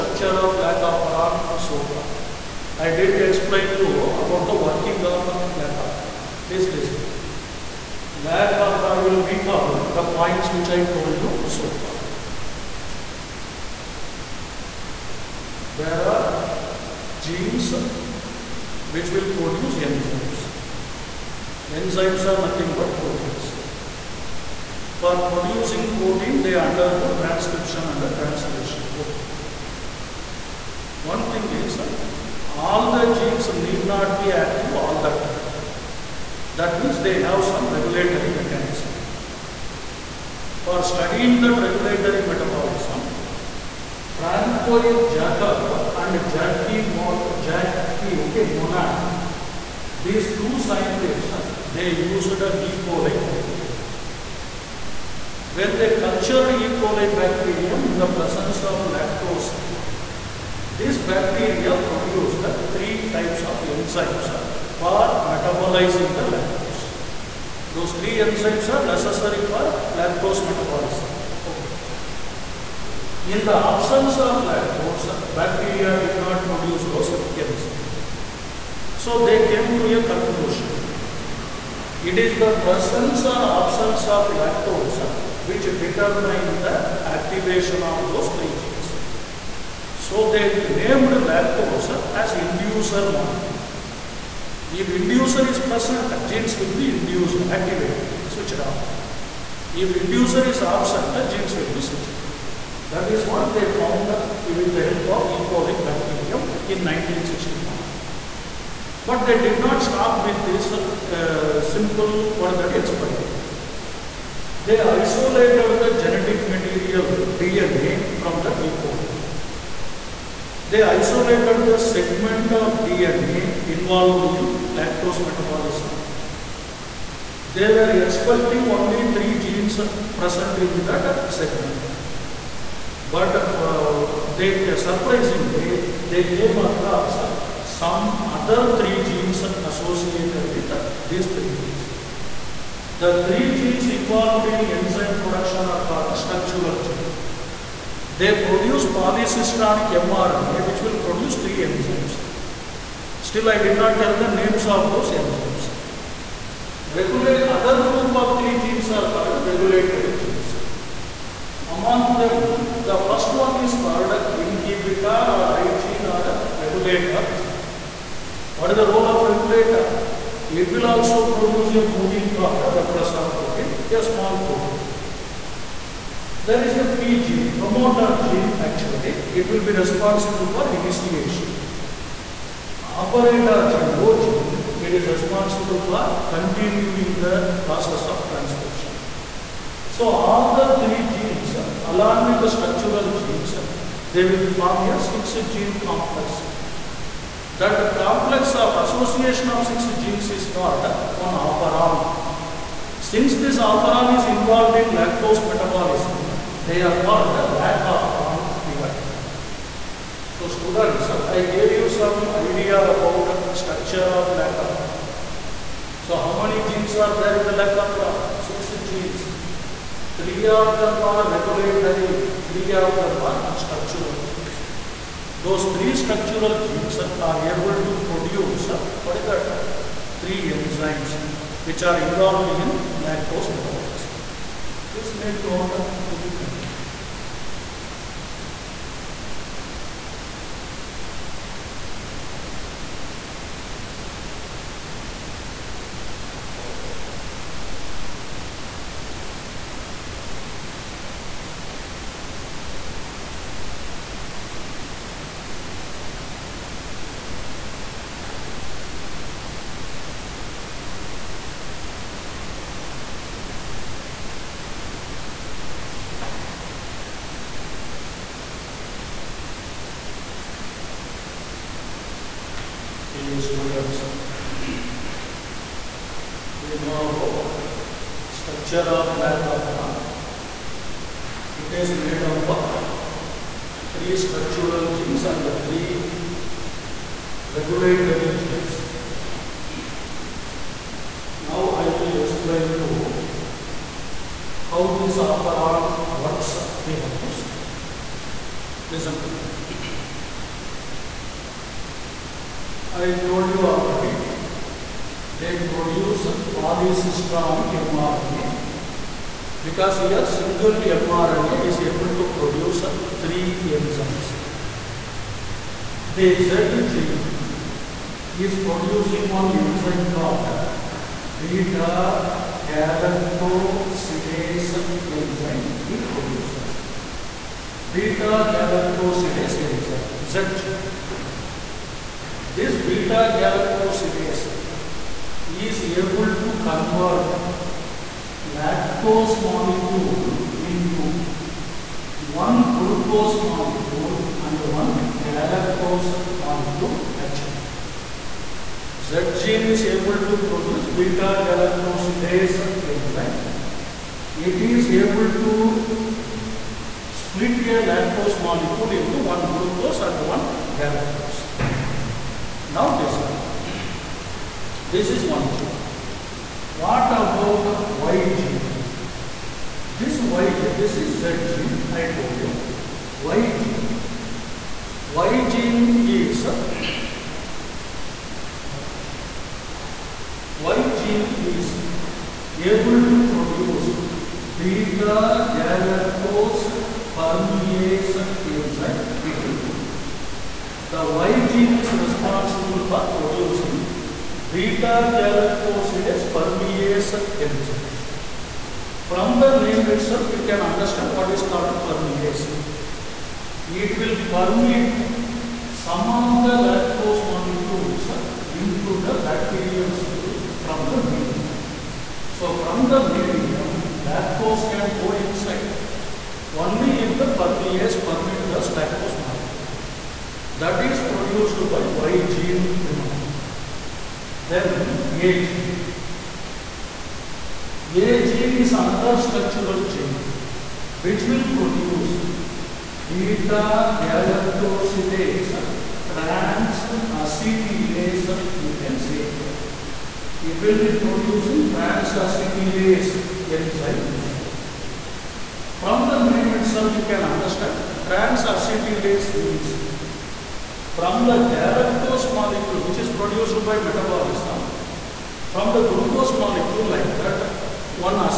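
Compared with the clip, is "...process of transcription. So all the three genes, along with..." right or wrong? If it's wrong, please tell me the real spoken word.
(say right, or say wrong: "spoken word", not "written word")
right.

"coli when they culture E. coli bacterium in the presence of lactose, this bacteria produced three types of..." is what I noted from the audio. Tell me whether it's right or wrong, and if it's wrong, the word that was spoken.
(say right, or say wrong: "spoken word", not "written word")
right.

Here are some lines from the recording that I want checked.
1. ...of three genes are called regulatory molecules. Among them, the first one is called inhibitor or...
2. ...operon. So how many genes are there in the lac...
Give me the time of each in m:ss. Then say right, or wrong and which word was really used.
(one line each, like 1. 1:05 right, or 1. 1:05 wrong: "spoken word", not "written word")
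1. 2:38 wrong: "genes", not "molecules"
2. 3:34 right.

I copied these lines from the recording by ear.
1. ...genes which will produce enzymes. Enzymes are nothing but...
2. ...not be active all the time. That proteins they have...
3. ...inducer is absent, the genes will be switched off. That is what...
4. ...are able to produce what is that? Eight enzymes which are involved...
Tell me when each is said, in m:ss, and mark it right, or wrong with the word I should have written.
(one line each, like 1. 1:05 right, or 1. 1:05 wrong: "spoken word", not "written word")
1. 0:17 right
2. 0:33 wrong: "means", not "proteins"
3. 1:39 right
4. 3:46 wrong: "Three", not "Eight".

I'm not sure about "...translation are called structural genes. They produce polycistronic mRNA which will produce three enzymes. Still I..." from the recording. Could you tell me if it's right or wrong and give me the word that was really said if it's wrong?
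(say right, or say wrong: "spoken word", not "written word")
wrong: "production", not "translation".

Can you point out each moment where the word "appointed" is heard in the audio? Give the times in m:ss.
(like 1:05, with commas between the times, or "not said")
not said.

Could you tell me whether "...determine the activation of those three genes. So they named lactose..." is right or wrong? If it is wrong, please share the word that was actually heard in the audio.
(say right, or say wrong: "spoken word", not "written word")
right.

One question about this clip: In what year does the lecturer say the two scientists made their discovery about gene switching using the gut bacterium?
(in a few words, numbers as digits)
1960.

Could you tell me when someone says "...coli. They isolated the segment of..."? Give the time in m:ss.
1:58.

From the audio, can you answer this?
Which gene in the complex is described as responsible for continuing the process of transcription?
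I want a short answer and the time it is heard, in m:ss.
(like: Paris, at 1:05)
operator gene, at 3:02.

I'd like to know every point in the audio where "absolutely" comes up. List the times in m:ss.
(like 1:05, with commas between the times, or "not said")
not said.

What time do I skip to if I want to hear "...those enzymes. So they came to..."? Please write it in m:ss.
1:16.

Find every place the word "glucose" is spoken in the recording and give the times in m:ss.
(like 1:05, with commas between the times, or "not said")
5:42, 5:59, 7:35.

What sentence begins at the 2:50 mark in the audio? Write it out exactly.
It will also produce a protein called a repressor protein, a small protein.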